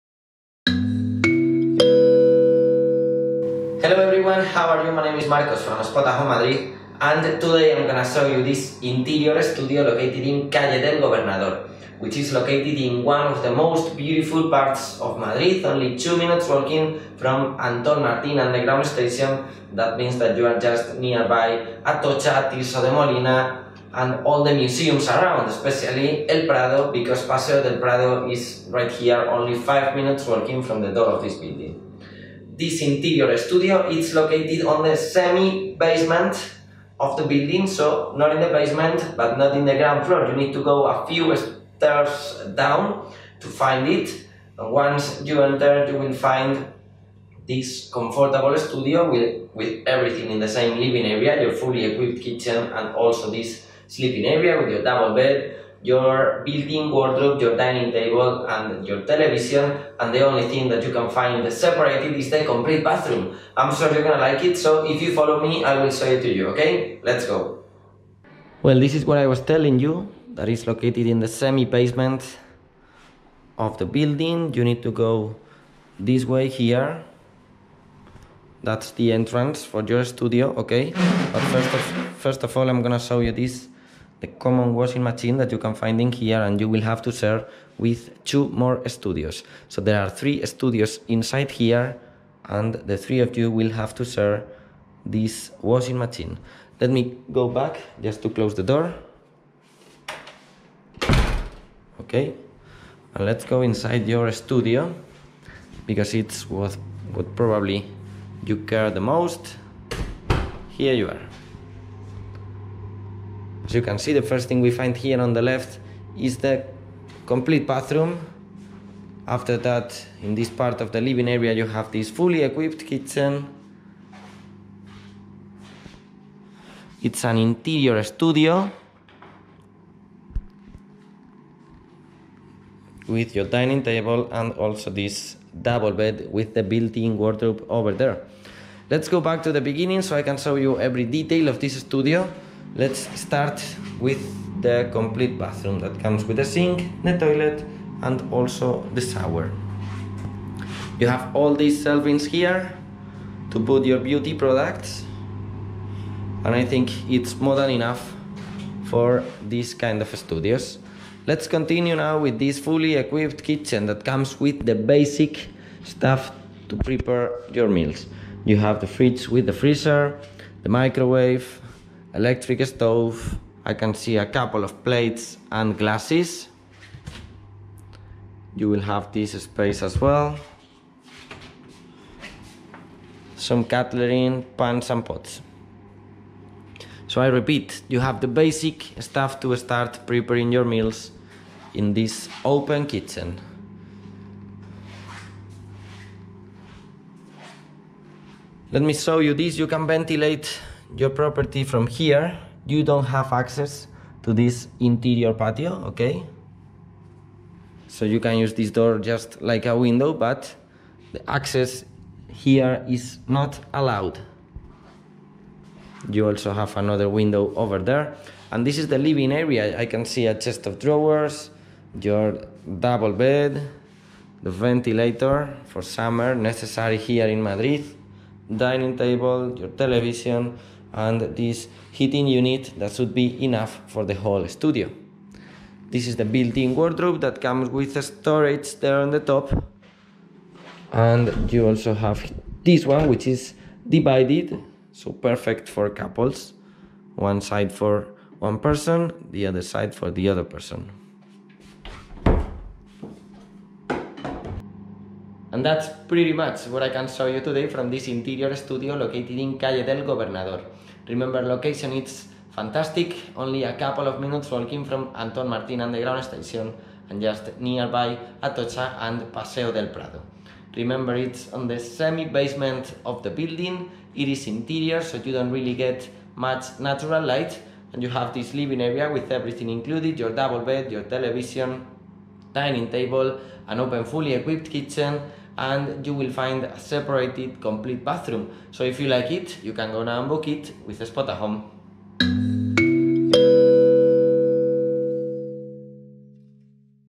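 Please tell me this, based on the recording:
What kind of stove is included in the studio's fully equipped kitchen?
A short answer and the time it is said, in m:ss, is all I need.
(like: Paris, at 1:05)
Electric, at 2:52.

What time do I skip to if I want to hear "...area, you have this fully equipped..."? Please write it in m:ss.
2:01.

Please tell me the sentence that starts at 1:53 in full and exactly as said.
As you can see, the first thing we find here on the left is the complete bathroom.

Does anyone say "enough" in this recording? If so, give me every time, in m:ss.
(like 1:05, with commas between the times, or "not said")
2:37, 3:53.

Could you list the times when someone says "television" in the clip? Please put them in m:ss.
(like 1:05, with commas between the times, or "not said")
0:59, 3:49, 4:41.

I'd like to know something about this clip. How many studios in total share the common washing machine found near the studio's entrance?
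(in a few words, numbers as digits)
3.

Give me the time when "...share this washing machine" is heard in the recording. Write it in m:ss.
1:34.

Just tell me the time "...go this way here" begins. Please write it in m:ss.
1:14.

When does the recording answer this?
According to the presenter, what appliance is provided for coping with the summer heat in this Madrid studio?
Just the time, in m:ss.
3:44.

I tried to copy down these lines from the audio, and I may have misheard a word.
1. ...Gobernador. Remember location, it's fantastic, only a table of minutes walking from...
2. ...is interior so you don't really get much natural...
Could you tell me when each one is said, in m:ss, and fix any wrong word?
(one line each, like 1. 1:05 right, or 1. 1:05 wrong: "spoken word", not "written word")
1. 4:20 wrong: "couple", not "table"
2. 4:34 right.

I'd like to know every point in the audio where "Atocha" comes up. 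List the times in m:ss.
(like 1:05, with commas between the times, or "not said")
0:21, 4:28.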